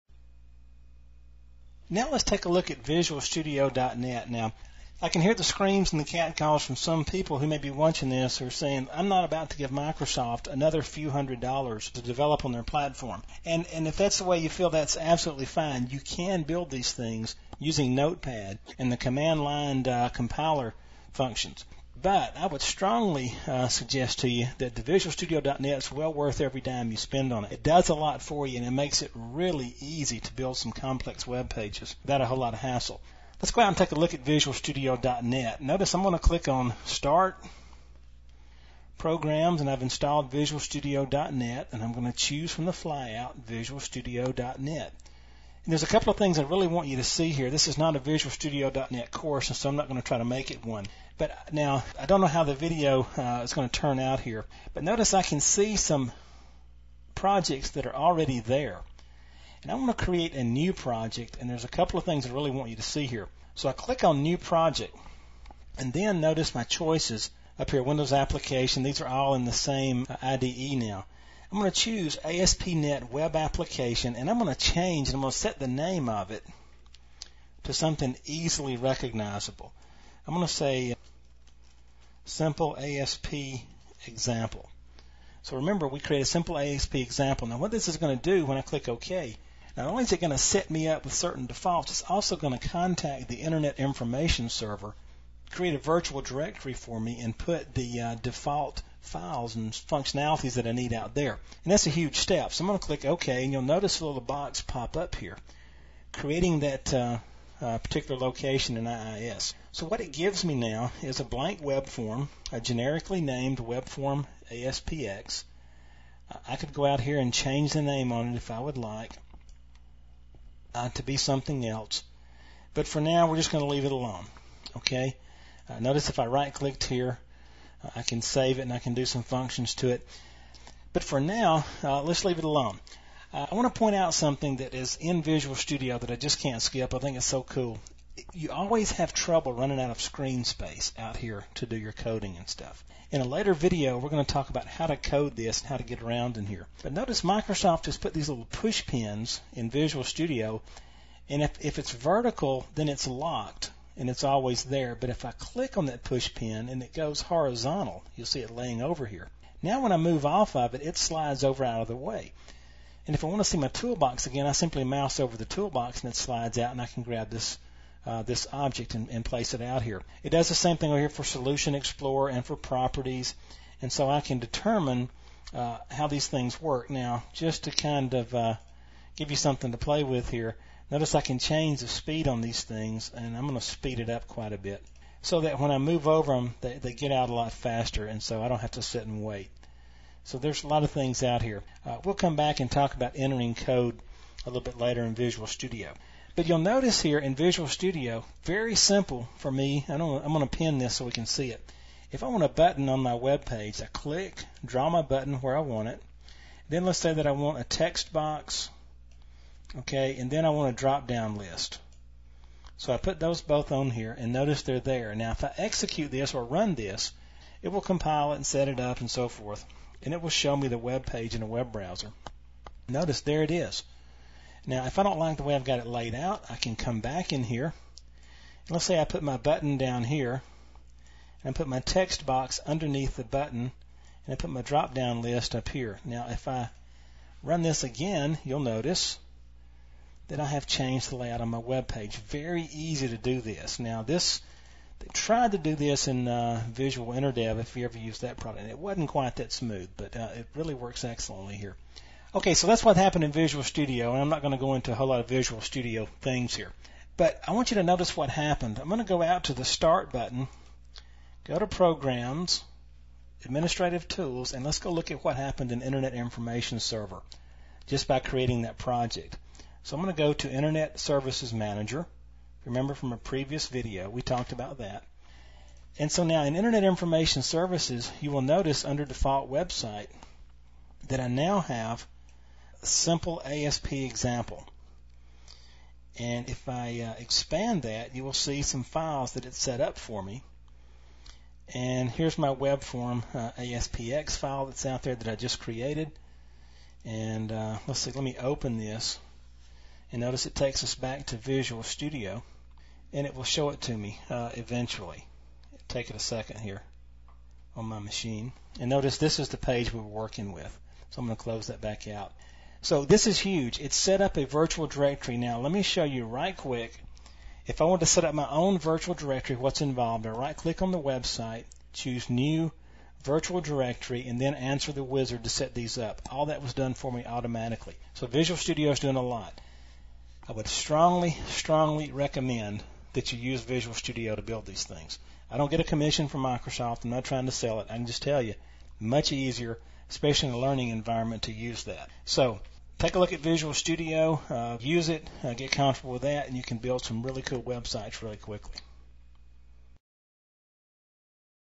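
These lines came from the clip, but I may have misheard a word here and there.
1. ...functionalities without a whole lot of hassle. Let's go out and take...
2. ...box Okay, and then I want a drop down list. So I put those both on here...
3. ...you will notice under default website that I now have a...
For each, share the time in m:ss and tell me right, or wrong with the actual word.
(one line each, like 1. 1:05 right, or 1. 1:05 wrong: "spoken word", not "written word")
1. 0:31 wrong: "pages", not "functionalities"
2. 3:28 right
3. 4:38 right.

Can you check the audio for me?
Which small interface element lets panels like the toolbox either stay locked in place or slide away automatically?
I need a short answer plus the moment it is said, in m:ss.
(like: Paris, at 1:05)
push pins, at 2:28.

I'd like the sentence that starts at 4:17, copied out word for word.
But I want you to notice what happened.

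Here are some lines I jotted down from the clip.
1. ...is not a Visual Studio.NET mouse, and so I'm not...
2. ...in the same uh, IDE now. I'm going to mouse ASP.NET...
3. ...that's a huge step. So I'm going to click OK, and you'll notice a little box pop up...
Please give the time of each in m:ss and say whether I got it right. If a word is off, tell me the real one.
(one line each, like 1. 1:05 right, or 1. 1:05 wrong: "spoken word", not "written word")
1. 0:47 wrong: "course", not "mouse"
2. 1:09 wrong: "choose", not "mouse"
3. 1:41 right.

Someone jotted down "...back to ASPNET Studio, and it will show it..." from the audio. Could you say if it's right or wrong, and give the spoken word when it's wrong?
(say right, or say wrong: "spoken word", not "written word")
wrong: "Visual", not "ASPNET".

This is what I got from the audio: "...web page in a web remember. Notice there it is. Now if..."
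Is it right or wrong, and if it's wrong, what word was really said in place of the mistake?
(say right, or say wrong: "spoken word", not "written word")
wrong: "browser", not "remember".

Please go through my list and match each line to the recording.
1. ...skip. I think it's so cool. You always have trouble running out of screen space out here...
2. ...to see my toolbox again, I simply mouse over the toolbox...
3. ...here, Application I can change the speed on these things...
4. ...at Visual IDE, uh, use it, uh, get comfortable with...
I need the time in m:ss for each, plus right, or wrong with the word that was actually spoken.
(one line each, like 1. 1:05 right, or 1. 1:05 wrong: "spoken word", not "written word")
1. 2:16 right
2. 2:43 right
3. 3:00 wrong: "Notice", not "Application"
4. 5:43 wrong: "Studio", not "IDE".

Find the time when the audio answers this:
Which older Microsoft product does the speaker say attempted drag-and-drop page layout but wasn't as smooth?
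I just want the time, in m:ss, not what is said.
4:06.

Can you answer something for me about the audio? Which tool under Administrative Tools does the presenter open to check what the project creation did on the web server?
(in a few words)
Internet Services Manager.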